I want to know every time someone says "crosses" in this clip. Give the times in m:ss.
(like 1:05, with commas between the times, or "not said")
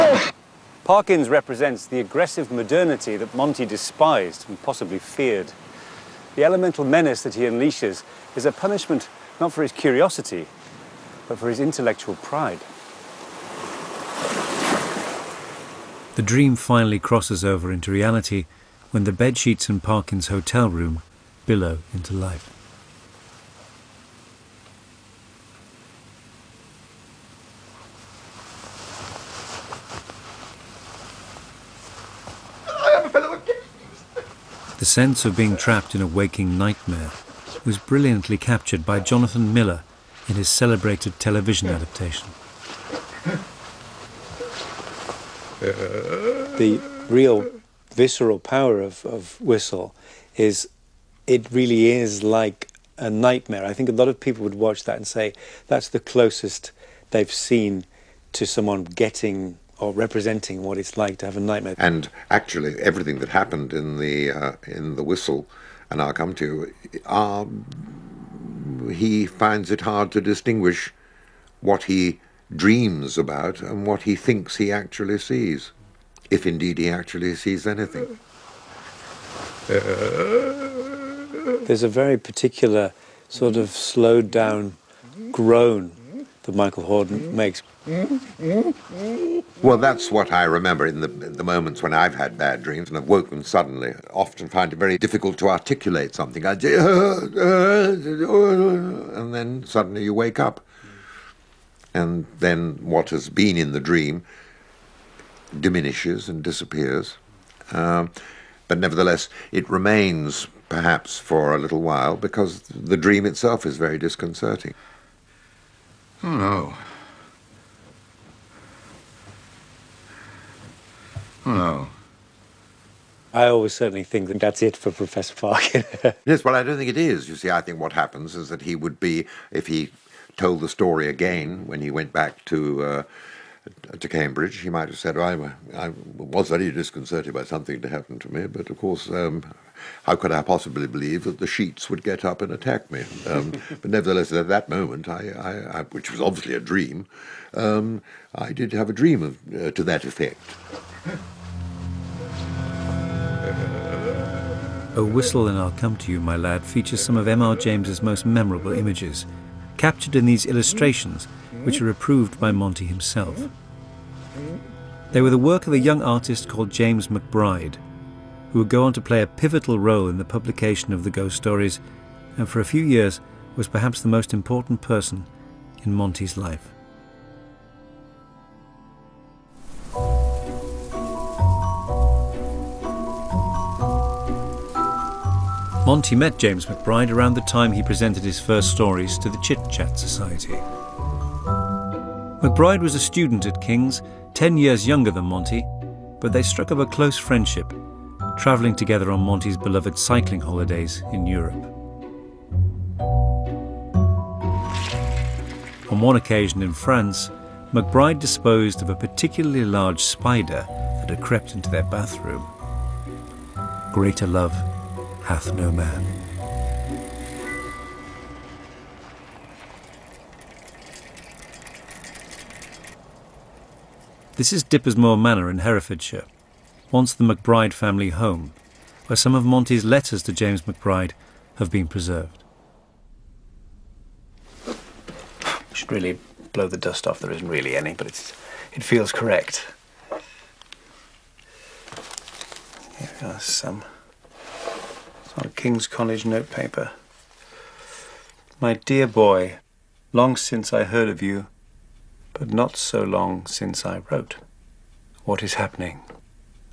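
0:16.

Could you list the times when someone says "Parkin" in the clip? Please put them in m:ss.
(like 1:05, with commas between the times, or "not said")
0:00, 0:19, 2:05.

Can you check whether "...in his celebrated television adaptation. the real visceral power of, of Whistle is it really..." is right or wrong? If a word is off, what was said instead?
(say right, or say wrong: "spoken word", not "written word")
right.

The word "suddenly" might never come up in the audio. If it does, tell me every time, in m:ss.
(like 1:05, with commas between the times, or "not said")
1:33, 1:39.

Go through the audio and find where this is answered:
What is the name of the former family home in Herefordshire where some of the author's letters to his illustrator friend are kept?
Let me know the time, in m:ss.
3:44.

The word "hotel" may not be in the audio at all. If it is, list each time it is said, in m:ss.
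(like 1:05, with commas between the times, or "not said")
0:20.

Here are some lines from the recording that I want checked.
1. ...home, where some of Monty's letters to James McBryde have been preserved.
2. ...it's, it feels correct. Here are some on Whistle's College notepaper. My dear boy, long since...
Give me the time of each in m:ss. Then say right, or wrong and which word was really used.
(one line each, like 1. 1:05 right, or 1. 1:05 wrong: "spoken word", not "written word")
1. 3:48 right
2. 3:58 wrong: "King", not "Whistle".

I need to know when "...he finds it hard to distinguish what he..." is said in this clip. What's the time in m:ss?
1:08.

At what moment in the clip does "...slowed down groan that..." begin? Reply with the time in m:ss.
1:23.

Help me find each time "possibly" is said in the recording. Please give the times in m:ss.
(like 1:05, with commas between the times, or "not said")
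0:04, 2:20.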